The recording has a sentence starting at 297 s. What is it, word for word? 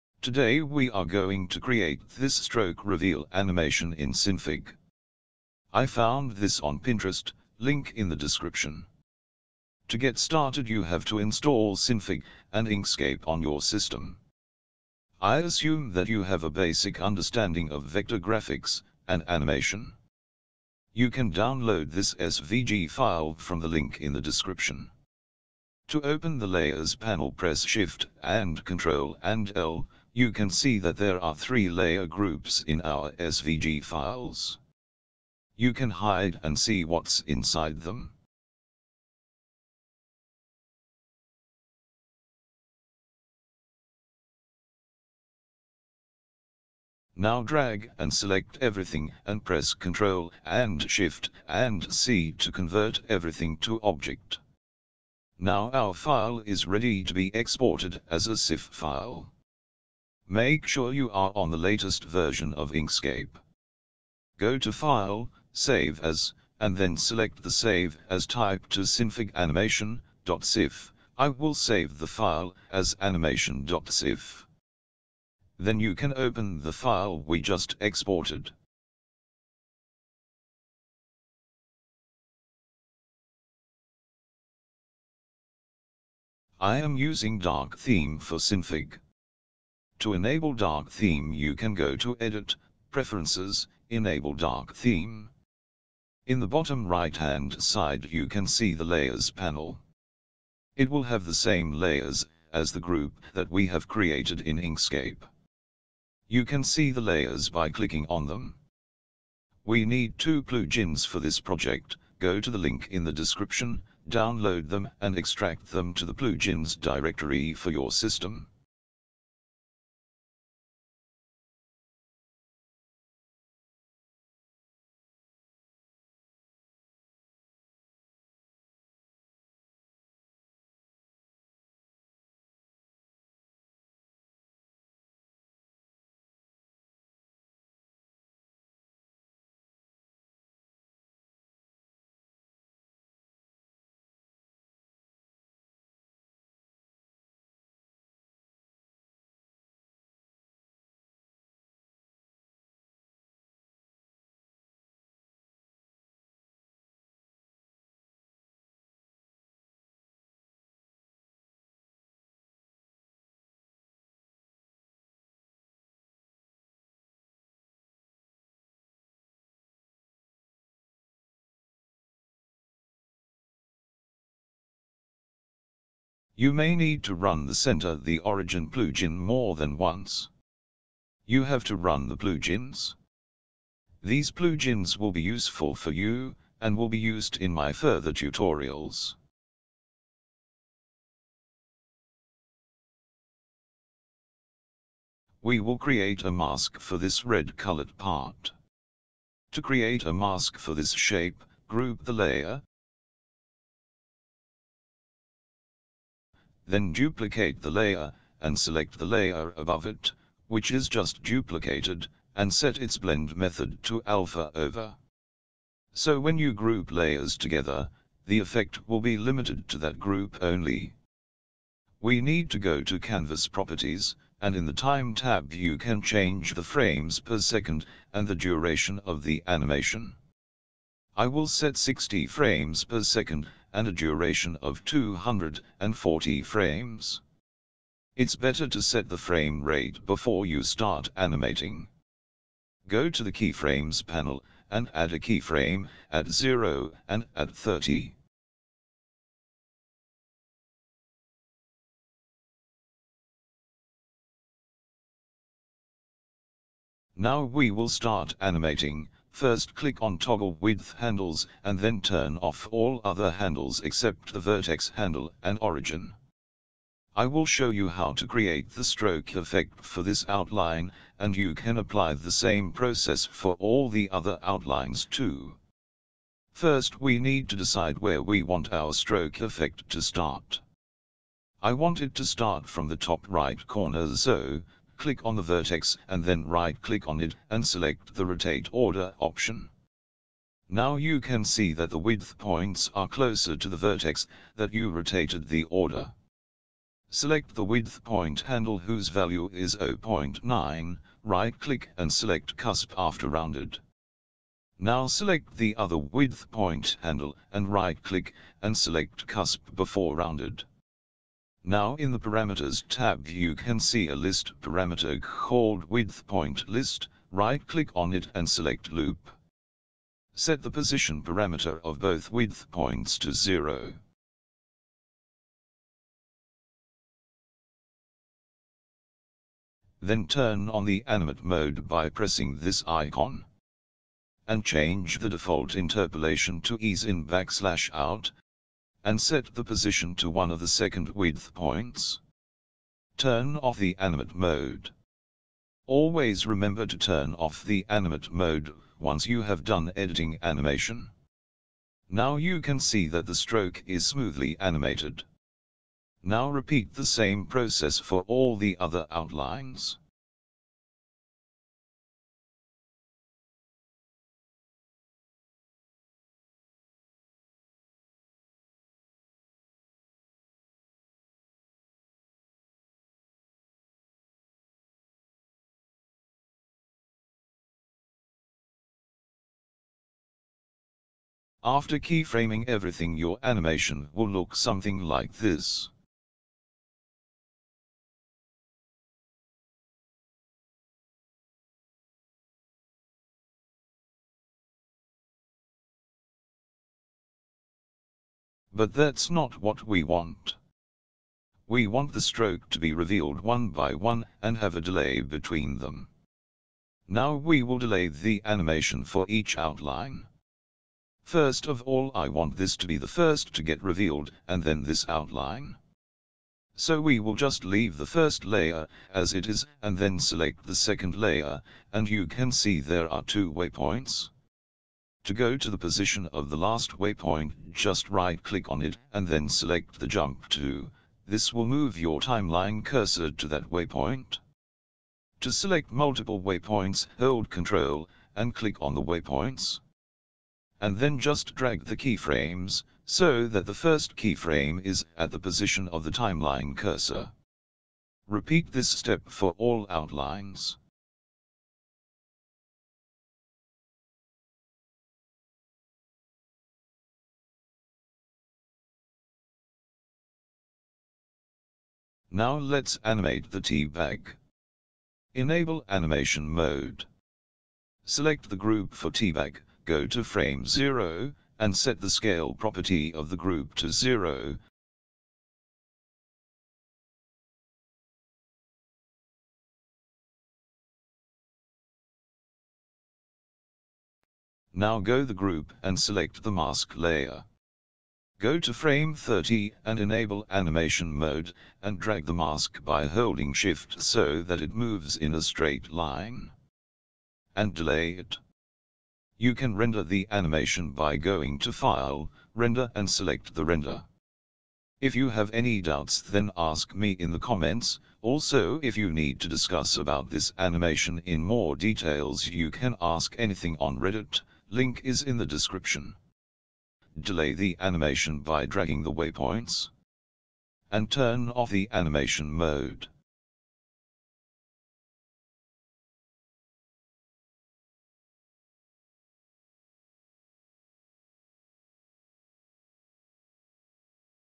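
Select the width point handle whose value is 0.9, right click and select cusp after rounded.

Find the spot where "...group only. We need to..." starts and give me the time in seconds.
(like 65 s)
219 s.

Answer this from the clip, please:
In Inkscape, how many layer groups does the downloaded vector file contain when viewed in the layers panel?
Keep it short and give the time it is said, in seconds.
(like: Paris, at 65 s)
3, at 31 s.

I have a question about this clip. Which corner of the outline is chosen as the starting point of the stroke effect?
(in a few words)
top right.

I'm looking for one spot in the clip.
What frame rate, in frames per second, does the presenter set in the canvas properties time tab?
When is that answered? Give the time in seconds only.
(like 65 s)
231 s.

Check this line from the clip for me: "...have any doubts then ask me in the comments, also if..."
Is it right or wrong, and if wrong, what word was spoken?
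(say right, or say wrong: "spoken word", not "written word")
right.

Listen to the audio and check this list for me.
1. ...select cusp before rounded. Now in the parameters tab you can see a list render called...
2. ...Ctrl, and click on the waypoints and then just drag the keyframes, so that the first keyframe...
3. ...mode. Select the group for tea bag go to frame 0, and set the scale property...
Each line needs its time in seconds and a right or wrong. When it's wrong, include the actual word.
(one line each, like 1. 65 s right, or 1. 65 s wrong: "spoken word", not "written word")
1. 308 s wrong: "parameter", not "render"
2. 437 s right
3. 466 s right.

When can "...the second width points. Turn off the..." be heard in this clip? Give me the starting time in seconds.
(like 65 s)
340 s.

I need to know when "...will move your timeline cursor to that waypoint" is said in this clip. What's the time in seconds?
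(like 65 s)
431 s.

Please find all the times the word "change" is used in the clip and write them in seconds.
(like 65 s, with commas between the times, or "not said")
226 s, 334 s.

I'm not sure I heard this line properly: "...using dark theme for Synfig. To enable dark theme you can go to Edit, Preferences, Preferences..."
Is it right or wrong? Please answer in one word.
wrong.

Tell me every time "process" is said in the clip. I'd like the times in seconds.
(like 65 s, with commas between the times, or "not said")
272 s, 357 s.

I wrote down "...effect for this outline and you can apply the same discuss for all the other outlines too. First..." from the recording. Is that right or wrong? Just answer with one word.
wrong.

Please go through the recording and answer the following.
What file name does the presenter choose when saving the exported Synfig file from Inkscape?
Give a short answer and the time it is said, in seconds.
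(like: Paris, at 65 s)
animation.sif, at 73 s.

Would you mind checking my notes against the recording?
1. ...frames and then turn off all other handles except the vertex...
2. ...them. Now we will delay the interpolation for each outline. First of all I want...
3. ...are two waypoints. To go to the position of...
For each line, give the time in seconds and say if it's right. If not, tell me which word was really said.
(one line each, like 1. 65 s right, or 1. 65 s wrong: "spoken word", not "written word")
1. 260 s wrong: "handles", not "frames"
2. 405 s wrong: "animation", not "interpolation"
3. 423 s right.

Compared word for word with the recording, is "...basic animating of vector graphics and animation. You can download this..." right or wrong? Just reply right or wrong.
wrong.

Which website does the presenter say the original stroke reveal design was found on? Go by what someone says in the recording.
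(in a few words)
Pinterest.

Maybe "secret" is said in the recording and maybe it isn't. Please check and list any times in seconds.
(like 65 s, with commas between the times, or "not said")
not said.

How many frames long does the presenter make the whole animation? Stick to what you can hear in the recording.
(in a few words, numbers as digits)
240.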